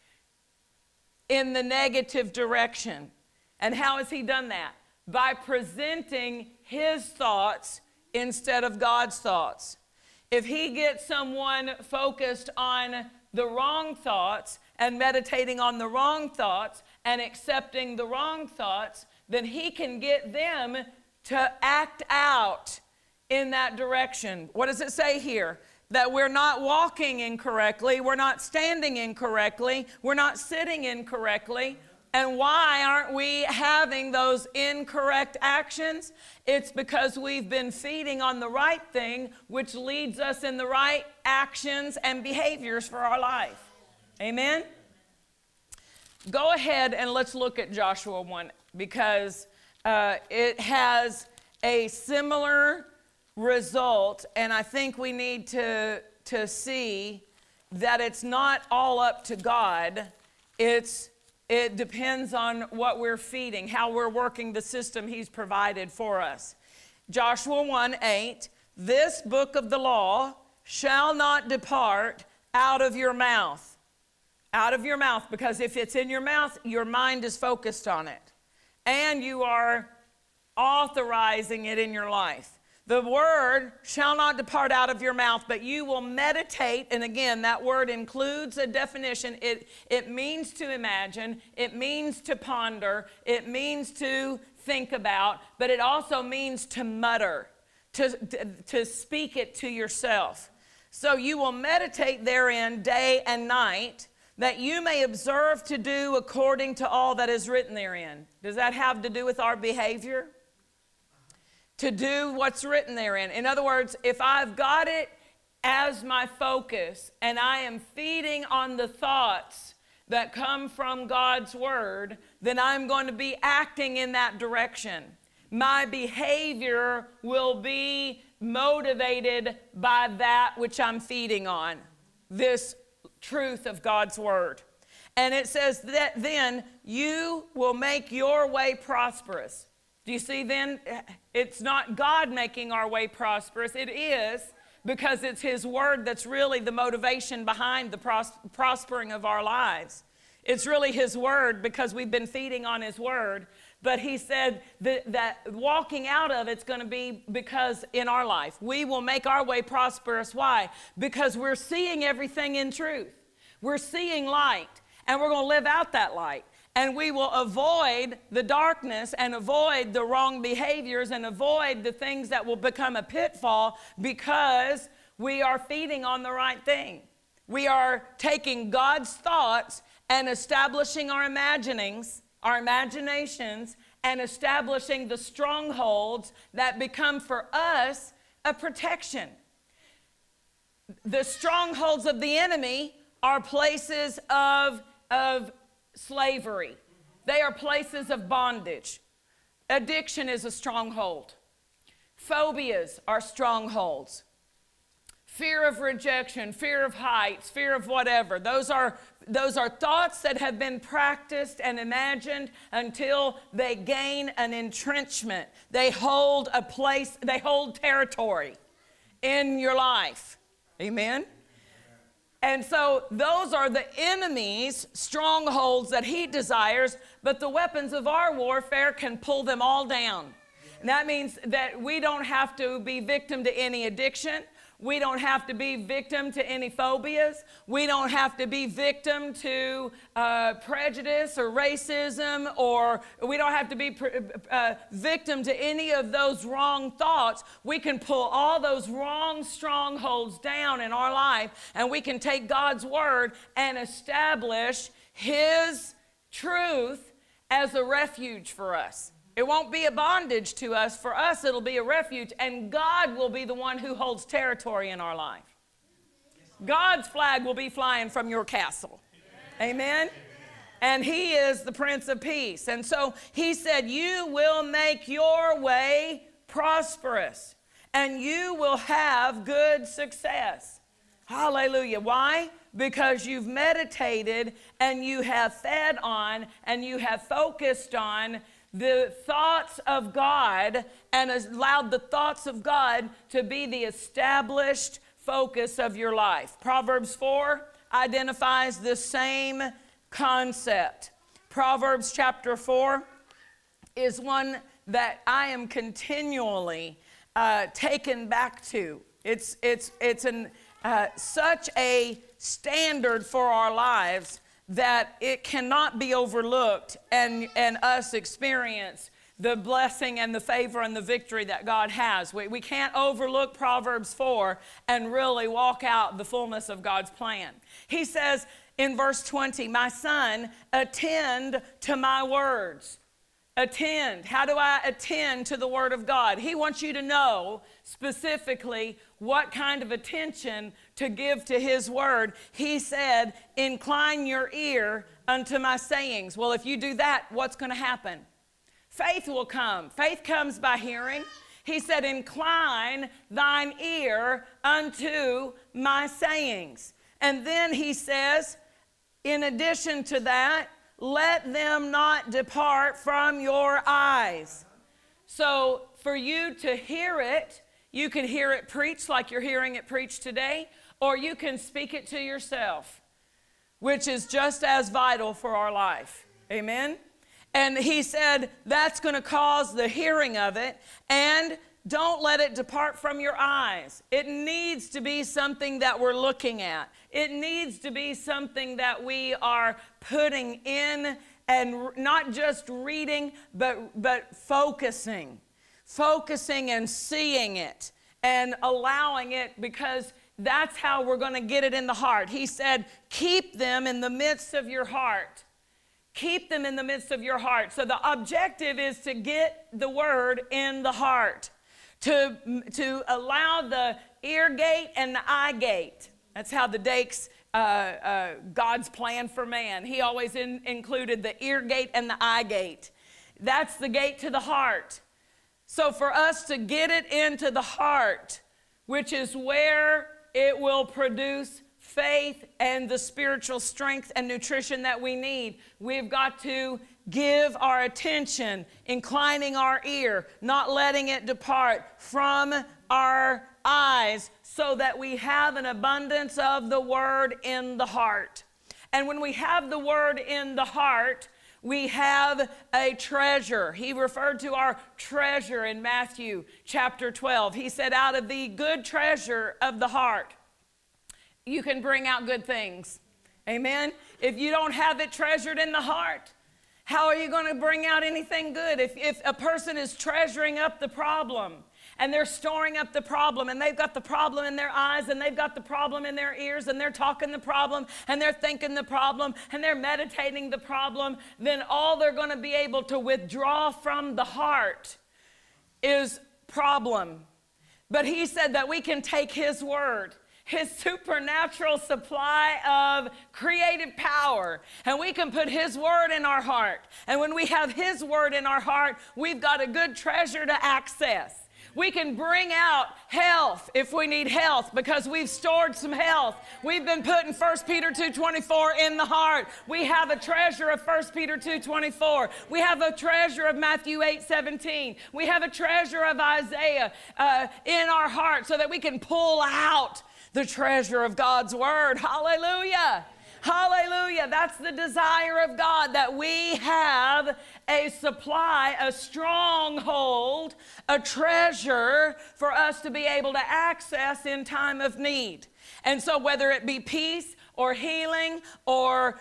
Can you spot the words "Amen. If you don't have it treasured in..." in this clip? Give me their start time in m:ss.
7:43.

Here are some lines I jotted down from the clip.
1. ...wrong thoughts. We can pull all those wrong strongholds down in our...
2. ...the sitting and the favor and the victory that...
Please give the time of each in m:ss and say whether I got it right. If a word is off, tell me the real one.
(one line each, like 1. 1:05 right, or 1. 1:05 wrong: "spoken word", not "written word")
1. 4:06 right
2. 5:19 wrong: "blessing", not "sitting".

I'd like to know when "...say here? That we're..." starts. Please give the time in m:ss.
0:24.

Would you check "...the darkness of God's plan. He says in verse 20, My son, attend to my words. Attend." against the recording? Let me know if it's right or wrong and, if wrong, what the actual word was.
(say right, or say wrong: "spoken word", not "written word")
wrong: "fullness", not "darkness".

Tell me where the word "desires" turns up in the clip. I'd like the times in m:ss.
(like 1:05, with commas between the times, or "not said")
3:46, 8:44.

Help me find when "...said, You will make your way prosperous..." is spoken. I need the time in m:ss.
4:33.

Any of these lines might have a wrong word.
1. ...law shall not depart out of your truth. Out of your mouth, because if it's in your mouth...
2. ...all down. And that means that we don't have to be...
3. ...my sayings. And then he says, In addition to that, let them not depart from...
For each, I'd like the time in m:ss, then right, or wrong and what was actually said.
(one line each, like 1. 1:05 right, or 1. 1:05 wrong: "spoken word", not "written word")
1. 1:09 wrong: "mouth", not "truth"
2. 3:49 right
3. 5:55 right.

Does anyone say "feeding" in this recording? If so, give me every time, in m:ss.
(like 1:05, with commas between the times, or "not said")
0:37, 1:03, 1:57, 2:10, 2:32, 2:55.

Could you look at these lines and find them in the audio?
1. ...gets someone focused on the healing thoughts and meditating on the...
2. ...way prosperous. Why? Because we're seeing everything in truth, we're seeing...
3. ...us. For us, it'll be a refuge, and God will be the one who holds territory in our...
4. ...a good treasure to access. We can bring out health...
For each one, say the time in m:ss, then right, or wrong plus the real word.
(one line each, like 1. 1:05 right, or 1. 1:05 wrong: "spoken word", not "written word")
1. 0:10 wrong: "wrong", not "healing"
2. 2:39 right
3. 4:20 right
4. 8:19 right.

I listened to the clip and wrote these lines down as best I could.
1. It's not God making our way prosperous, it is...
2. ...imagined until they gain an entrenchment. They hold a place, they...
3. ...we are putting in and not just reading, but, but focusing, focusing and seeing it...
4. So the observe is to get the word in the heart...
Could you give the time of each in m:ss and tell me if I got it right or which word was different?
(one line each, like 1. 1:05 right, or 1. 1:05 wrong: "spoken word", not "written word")
1. 2:21 right
2. 3:31 right
3. 6:29 right
4. 6:47 wrong: "objective", not "observe".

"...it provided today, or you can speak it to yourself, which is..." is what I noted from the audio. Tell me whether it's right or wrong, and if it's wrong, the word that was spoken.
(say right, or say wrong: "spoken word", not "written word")
wrong: "preached", not "provided".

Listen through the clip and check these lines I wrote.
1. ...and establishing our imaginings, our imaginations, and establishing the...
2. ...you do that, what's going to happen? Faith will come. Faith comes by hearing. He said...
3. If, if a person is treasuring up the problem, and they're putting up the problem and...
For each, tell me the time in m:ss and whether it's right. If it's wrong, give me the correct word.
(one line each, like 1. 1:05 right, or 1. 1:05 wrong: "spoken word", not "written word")
1. 3:00 right
2. 5:46 right
3. 7:48 wrong: "storing", not "putting".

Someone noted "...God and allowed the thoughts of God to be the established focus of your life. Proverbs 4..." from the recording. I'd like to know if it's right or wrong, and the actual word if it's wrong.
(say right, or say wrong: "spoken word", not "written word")
right.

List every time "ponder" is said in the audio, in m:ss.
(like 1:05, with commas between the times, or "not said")
1:32.